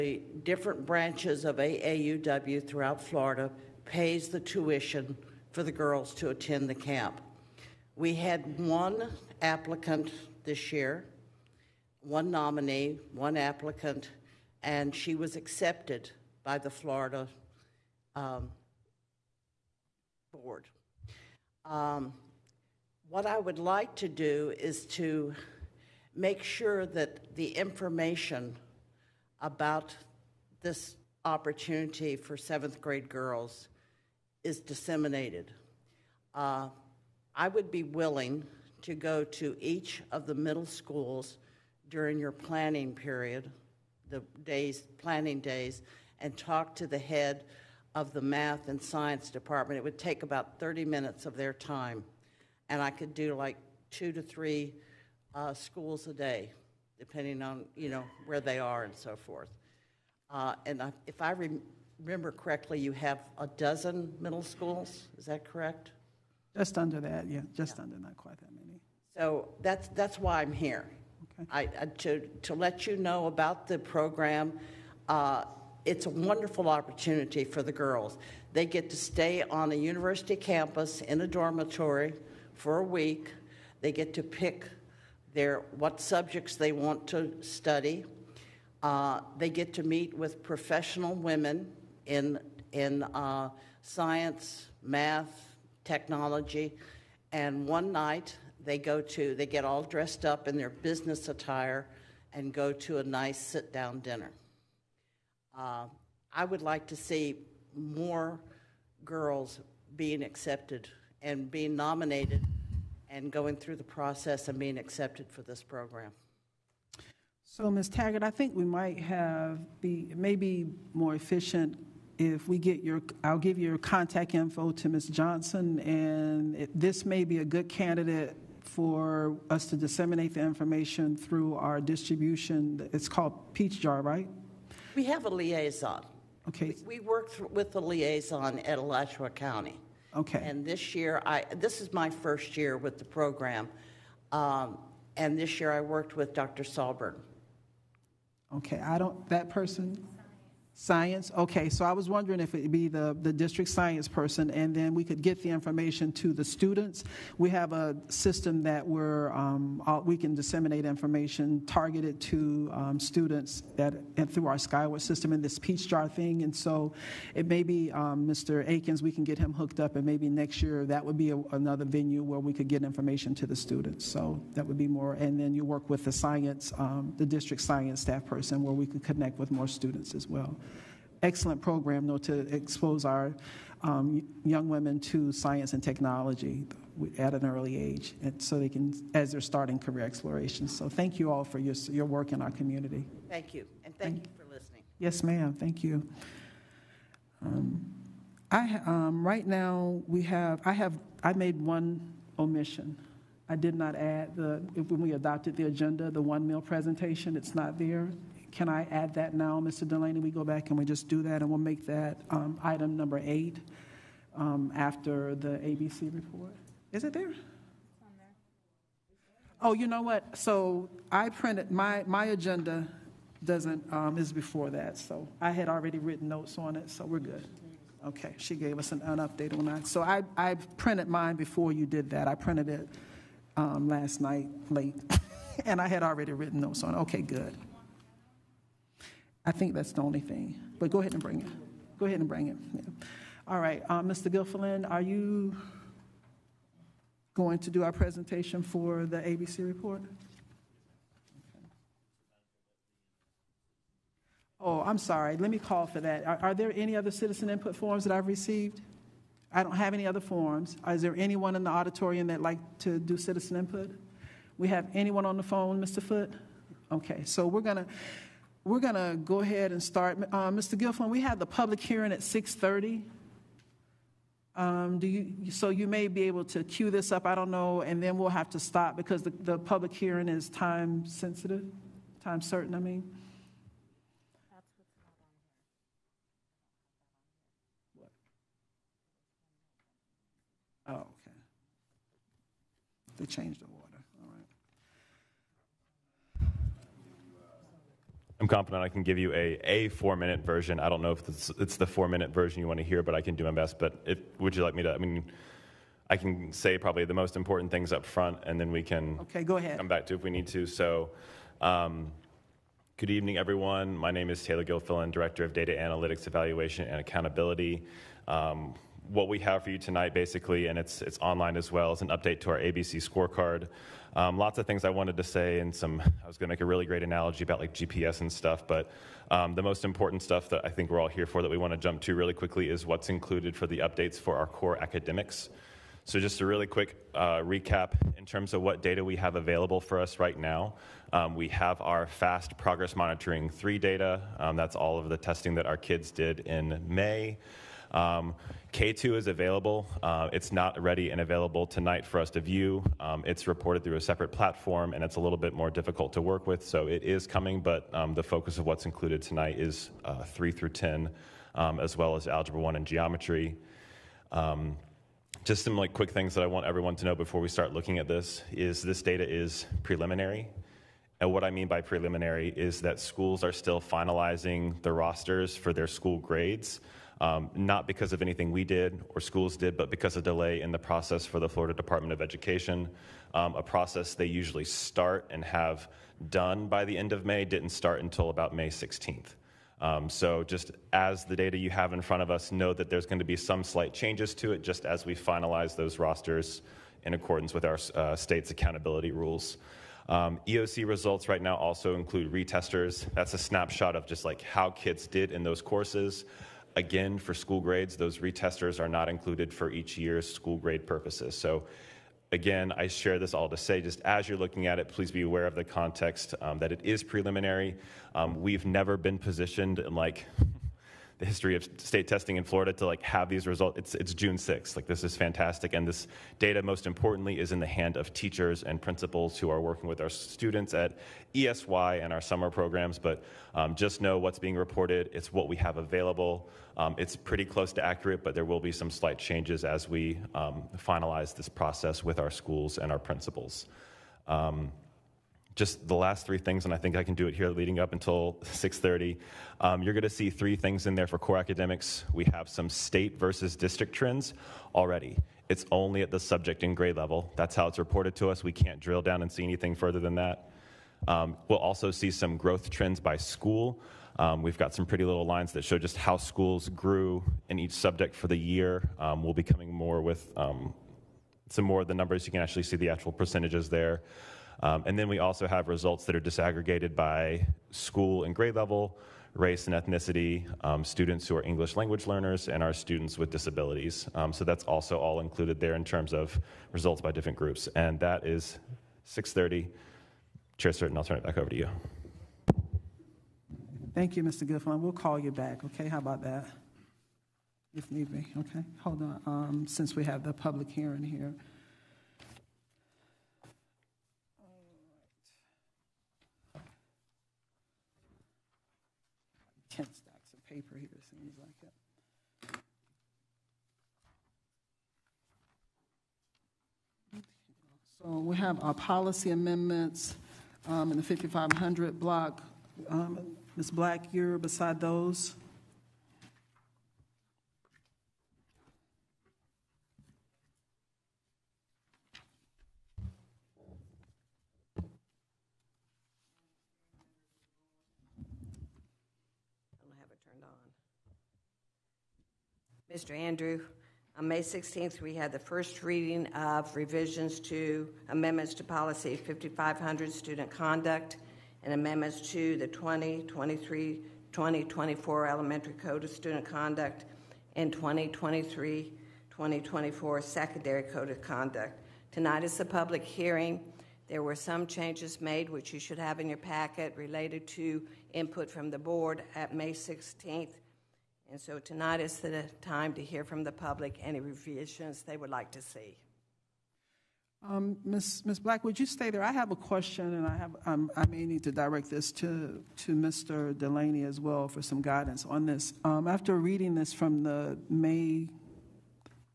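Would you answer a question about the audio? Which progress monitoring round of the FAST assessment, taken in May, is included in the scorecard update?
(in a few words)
Progress Monitoring 3.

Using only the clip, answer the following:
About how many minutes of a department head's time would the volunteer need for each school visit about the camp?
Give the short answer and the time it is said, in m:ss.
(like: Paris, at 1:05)
30, at 0:50.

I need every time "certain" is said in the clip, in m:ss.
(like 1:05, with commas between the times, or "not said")
4:42, 8:10.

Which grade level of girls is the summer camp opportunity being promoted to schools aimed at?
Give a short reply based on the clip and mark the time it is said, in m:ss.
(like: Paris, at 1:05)
7th grade, at 0:32.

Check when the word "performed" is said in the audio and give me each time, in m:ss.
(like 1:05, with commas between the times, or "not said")
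not said.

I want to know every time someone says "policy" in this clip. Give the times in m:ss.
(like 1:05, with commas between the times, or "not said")
8:38, 9:08.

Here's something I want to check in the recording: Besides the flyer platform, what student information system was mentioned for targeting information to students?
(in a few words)
Skyward.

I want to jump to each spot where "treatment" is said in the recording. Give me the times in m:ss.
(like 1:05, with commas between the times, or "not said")
not said.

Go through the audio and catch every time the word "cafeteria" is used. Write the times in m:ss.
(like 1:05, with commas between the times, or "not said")
not said.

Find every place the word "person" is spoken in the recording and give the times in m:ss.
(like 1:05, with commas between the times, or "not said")
2:29, 2:34, 2:58.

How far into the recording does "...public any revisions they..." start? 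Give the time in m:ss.
9:33.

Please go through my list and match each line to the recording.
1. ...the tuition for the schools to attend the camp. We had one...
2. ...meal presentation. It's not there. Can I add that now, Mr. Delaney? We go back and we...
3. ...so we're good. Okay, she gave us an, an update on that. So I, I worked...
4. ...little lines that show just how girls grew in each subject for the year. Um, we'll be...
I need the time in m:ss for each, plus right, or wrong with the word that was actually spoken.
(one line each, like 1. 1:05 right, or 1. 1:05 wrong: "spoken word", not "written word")
1. 0:04 wrong: "girls", not "schools"
2. 3:26 right
3. 3:46 wrong: "printed", not "worked"
4. 7:45 wrong: "schools", not "girls".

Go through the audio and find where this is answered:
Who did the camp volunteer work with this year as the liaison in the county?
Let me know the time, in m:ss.
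2:26.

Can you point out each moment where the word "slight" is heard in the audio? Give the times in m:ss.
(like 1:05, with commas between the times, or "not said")
6:33, 7:18.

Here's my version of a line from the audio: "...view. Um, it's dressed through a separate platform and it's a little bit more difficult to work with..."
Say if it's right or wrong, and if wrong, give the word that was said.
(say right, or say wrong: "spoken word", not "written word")
wrong: "reported", not "dressed".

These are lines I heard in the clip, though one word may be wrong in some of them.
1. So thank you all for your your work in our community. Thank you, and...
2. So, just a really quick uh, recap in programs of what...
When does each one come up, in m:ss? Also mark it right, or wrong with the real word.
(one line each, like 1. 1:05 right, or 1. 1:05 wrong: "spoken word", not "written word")
1. 3:10 right
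2. 5:36 wrong: "terms", not "programs".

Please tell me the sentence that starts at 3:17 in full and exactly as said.
Um, I um, right now we have I have I made one omission.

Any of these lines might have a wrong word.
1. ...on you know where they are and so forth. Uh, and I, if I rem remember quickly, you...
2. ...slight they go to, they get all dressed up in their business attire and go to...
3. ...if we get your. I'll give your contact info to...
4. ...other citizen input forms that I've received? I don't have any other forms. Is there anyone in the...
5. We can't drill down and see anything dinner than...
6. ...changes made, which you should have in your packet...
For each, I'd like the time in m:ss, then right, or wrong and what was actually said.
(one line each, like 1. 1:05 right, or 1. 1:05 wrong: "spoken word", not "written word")
1. 0:57 wrong: "correctly", not "quickly"
2. 1:37 wrong: "night", not "slight"
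3. 2:02 right
4. 4:16 right
5. 7:38 wrong: "further", not "dinner"
6. 9:24 right.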